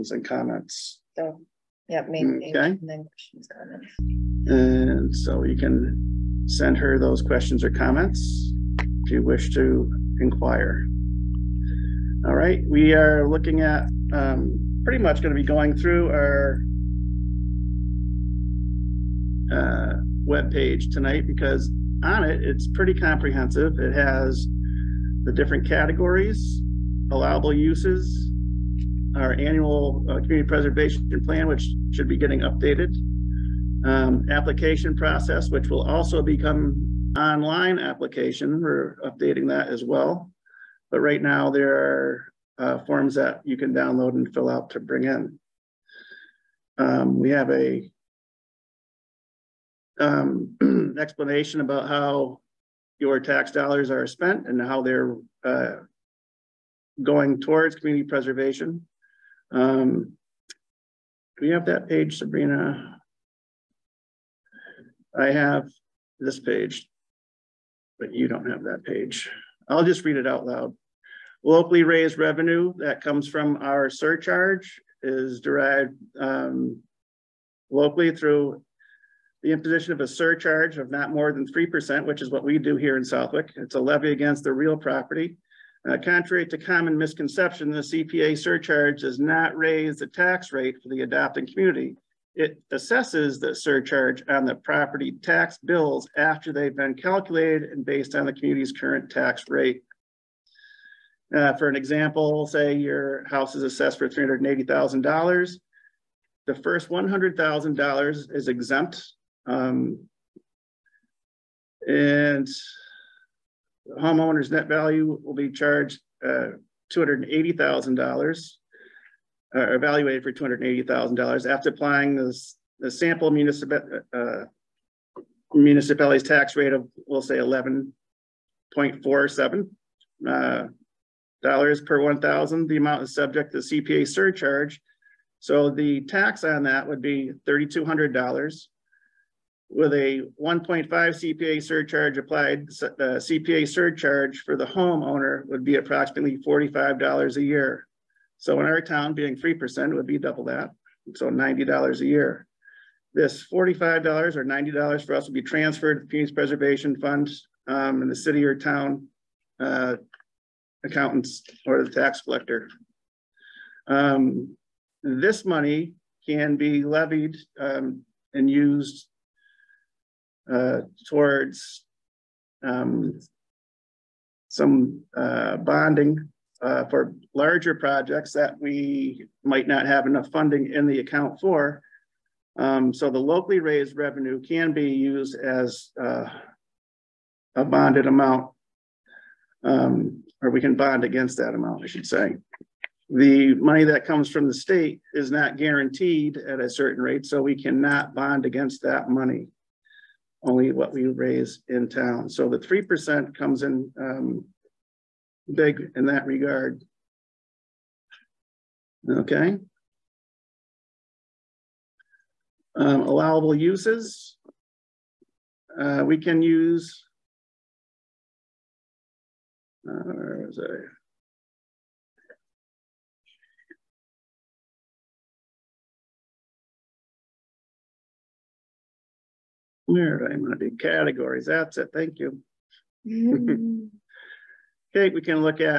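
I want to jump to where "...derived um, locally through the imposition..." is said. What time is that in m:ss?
1:15.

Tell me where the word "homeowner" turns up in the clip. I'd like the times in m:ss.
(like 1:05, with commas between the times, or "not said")
1:53, 2:24.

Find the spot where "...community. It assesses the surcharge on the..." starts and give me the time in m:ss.
1:31.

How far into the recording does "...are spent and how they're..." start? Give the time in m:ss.
0:53.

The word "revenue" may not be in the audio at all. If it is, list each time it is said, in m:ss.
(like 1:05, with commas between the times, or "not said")
1:12, 3:03.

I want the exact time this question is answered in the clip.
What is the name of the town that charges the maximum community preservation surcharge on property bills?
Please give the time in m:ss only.
1:23.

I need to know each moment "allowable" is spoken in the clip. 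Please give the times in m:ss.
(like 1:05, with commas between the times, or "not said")
0:27, 3:33.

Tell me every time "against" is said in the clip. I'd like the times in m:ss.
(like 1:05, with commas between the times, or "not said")
1:24, 3:11, 3:18.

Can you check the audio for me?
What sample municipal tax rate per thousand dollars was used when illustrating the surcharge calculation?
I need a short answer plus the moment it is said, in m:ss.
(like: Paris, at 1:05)
11.47, at 2:07.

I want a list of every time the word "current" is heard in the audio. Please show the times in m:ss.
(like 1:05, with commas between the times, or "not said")
1:38.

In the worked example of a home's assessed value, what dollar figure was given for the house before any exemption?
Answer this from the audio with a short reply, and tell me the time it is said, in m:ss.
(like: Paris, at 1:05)
$380,000, at 1:44.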